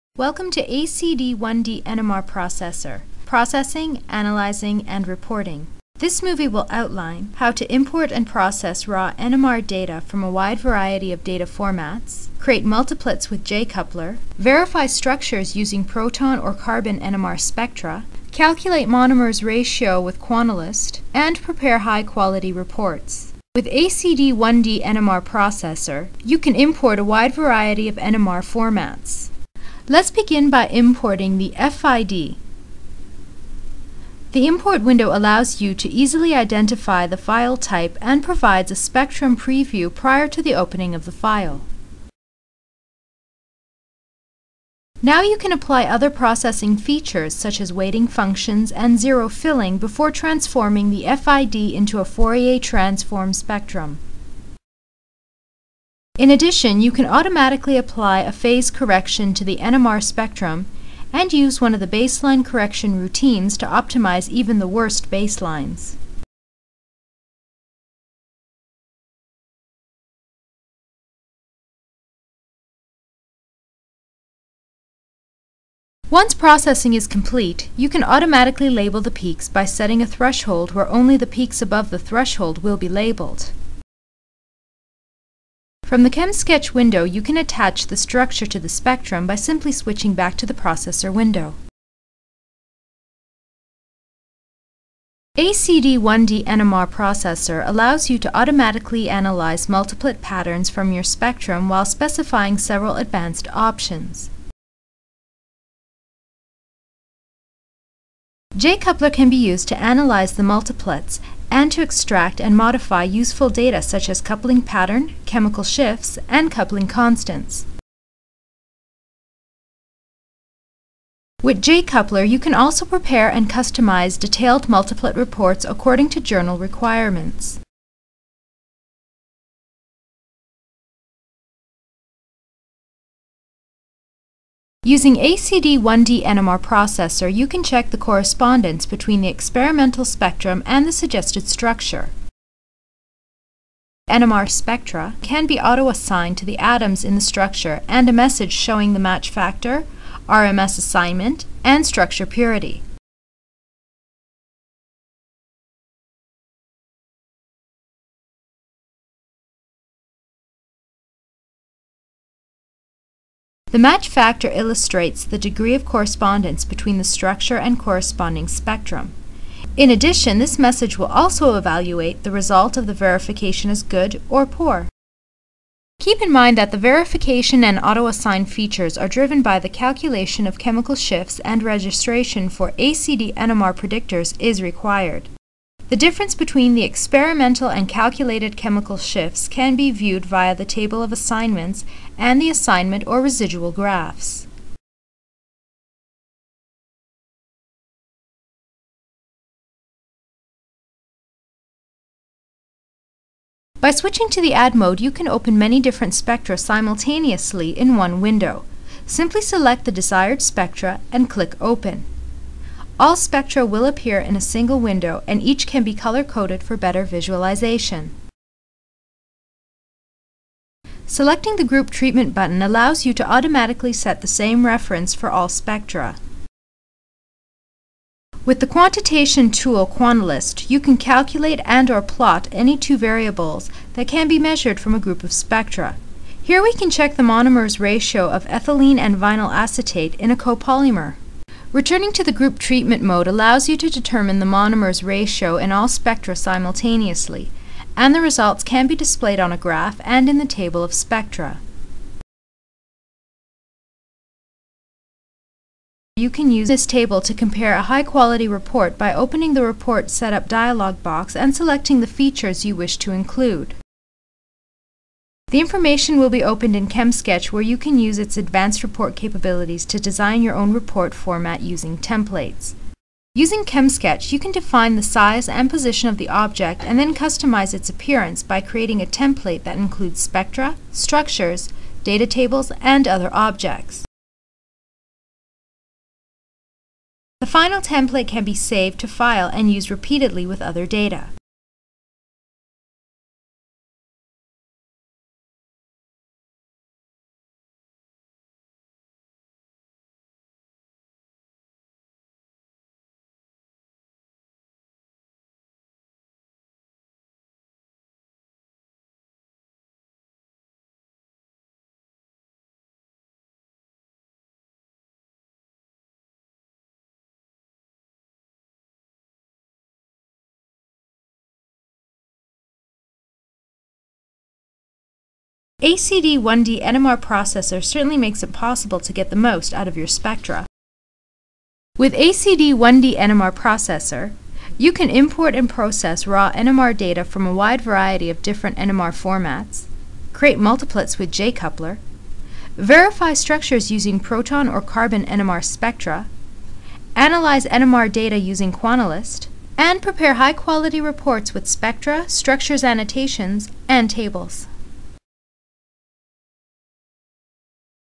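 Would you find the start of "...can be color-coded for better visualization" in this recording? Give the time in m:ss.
3:35.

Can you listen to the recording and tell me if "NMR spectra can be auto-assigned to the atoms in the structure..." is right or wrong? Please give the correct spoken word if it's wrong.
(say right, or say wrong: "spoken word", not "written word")
right.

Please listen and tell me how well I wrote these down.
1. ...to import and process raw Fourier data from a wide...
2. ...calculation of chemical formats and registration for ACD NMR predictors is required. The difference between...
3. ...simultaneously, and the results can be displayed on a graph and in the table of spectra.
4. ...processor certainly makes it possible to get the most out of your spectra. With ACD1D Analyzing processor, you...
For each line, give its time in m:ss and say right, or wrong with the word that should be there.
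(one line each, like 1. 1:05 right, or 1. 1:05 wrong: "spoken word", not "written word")
1. 0:07 wrong: "NMR", not "Fourier"
2. 2:59 wrong: "shifts", not "formats"
3. 4:06 right
4. 5:27 wrong: "NMR", not "Analyzing".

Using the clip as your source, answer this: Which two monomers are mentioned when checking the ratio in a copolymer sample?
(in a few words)
ethylene and vinyl acetate.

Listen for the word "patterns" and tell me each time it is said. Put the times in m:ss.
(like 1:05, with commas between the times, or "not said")
1:40, 1:54.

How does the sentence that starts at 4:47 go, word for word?
The final template can be saved to file and used repeatedly with other data.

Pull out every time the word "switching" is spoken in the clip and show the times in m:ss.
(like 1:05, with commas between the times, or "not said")
1:29, 3:23.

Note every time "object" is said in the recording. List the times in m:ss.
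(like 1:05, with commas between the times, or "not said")
4:36, 4:43.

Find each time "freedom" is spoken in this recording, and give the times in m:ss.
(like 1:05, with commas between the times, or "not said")
not said.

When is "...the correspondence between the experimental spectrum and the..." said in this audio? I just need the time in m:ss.
2:17.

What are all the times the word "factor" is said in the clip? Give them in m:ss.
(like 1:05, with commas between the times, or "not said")
2:29, 2:44.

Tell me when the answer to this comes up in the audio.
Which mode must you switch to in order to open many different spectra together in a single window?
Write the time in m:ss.
3:24.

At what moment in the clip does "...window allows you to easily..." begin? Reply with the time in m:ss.
0:34.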